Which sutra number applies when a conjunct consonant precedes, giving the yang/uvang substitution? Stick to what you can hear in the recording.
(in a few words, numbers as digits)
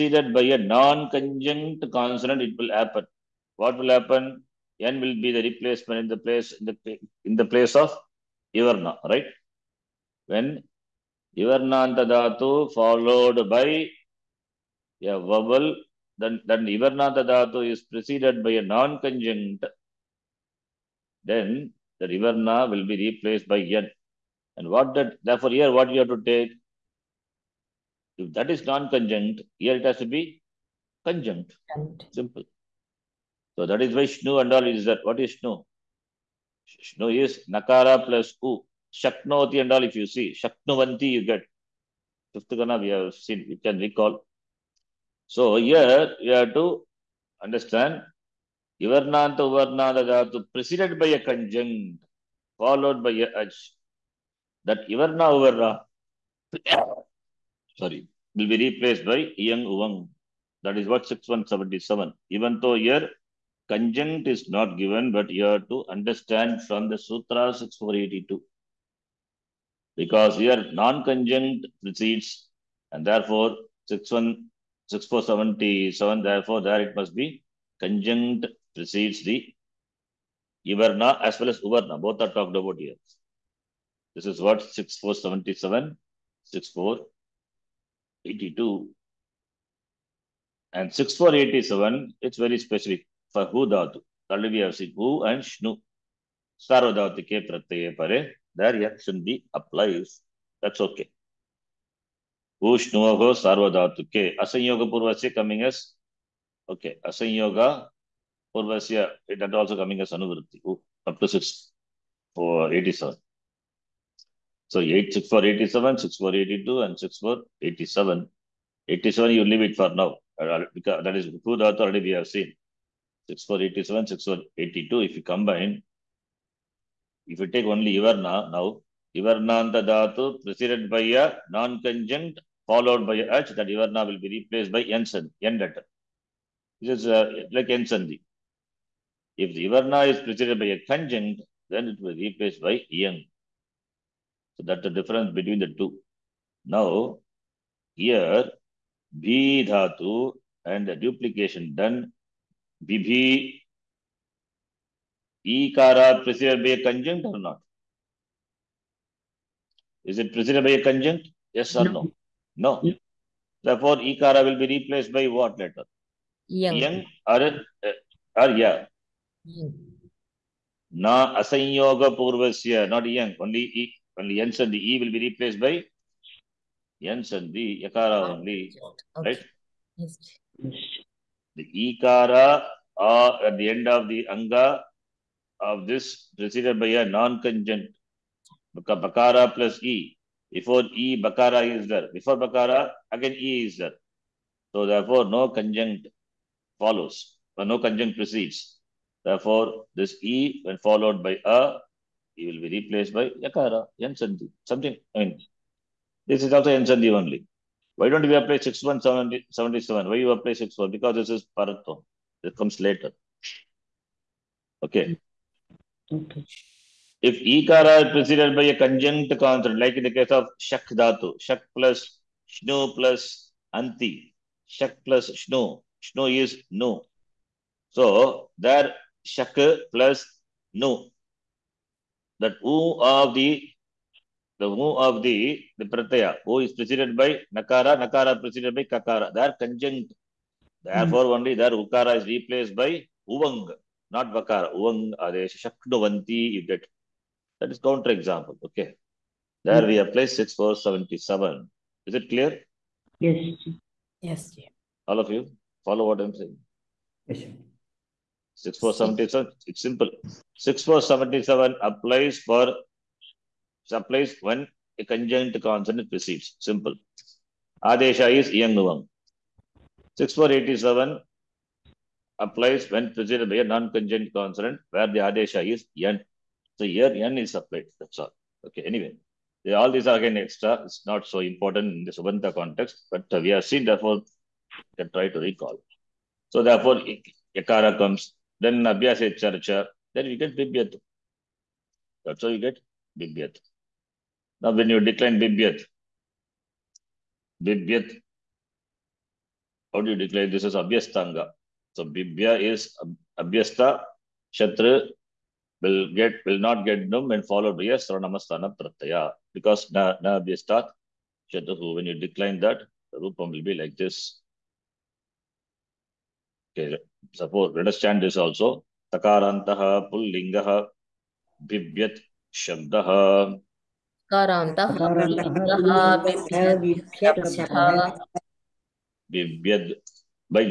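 6477.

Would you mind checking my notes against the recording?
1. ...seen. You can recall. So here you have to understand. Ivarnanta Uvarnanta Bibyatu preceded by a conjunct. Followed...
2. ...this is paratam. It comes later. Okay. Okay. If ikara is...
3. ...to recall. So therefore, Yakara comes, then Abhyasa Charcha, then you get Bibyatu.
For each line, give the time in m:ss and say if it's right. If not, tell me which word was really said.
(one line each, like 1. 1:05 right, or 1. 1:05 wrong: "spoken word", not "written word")
1. 0:43 wrong: "Dhatu", not "Bibyatu"
2. 3:31 right
3. 4:45 right.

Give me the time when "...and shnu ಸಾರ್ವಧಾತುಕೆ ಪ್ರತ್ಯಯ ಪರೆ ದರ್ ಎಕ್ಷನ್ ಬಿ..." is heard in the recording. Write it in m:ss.
1:35.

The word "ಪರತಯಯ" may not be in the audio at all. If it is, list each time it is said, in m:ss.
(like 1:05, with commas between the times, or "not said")
1:37.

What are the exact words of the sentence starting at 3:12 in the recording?
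Before bakara, again e is there.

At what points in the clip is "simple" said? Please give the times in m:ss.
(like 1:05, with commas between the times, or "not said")
0:32, 4:19, 4:26.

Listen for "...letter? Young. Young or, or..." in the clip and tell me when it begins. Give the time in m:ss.
2:45.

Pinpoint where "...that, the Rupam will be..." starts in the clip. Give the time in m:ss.
5:12.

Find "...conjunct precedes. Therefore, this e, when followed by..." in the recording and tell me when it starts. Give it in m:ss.
3:17.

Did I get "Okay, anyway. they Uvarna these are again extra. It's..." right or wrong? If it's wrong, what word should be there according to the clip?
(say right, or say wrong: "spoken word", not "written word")
wrong: "All", not "Uvarna".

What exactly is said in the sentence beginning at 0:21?
Then the Ivarna will be replaced by N.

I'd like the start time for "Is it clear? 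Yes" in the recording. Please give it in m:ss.
4:12.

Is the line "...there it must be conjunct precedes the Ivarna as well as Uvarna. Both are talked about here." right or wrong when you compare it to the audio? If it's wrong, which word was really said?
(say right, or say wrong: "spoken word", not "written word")
right.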